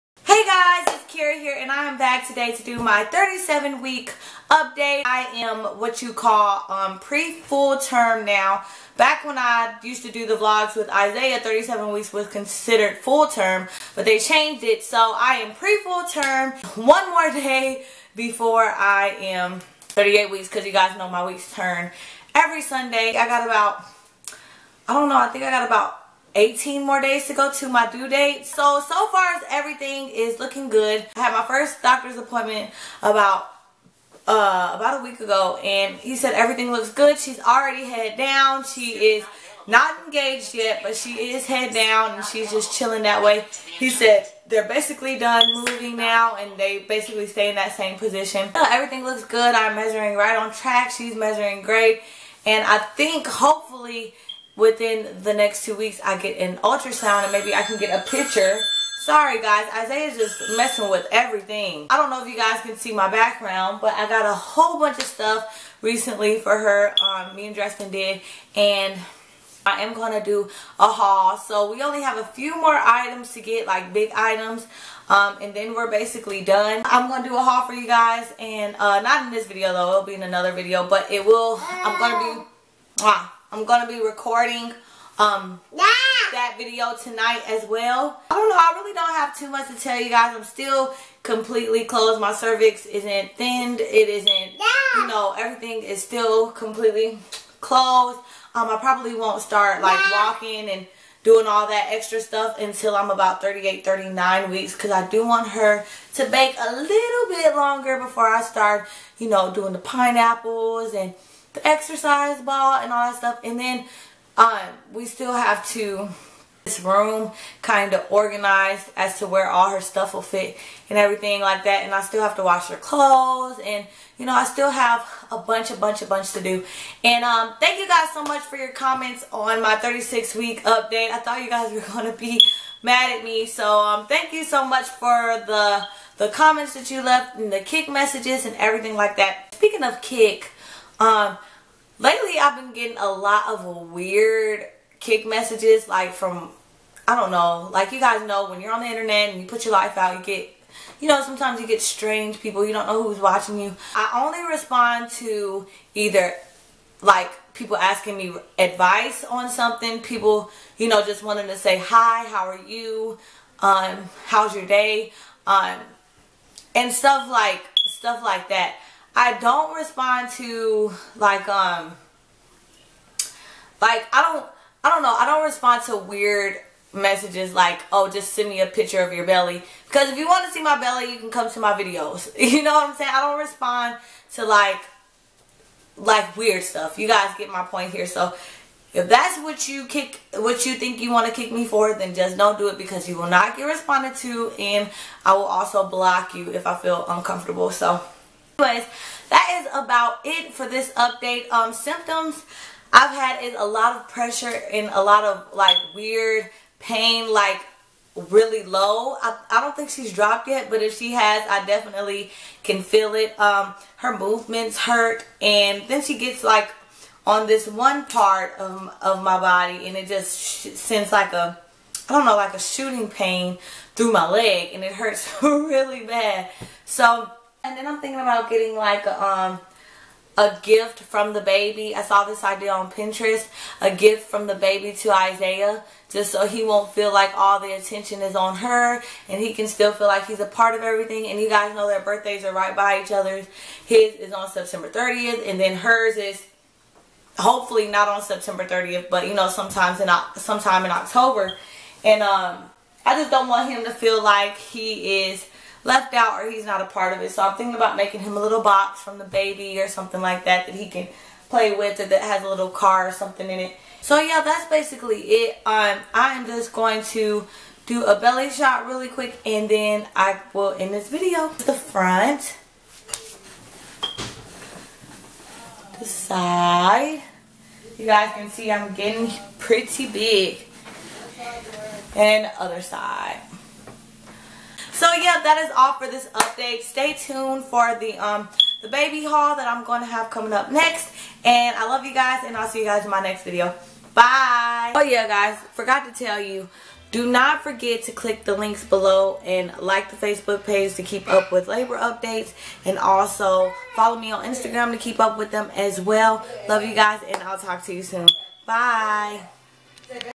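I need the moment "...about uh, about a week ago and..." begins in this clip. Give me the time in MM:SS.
00:33.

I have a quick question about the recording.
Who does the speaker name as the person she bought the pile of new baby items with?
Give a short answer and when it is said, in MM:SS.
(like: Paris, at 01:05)
Dresden, at 01:07.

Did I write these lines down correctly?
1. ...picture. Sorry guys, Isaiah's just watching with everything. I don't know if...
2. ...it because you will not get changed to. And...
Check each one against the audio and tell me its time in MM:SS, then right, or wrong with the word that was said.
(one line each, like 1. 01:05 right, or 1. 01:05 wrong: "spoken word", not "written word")
1. 00:58 wrong: "messing", not "watching"
2. 03:12 wrong: "responded", not "changed".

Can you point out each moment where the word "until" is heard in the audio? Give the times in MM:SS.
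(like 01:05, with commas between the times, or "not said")
01:42.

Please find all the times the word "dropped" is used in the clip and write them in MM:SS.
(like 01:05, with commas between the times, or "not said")
03:30.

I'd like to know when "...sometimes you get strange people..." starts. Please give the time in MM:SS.
02:31.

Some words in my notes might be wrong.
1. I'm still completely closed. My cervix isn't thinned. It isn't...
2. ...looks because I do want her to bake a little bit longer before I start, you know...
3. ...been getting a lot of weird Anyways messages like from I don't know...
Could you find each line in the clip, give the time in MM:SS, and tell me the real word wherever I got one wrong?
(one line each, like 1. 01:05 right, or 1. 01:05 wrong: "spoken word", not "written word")
1. 01:30 right
2. 01:44 wrong: "weeks", not "looks"
3. 02:22 wrong: "Kik", not "Anyways".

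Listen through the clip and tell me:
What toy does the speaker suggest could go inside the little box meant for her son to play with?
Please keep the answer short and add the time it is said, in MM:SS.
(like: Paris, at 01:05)
A little car, at 04:22.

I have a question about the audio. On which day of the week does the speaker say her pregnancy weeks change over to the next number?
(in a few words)
Sunday.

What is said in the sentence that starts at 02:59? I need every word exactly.
Because if you want to see my belly, you can come to my videos.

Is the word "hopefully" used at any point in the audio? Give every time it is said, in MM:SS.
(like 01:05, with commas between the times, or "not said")
00:53, 04:07.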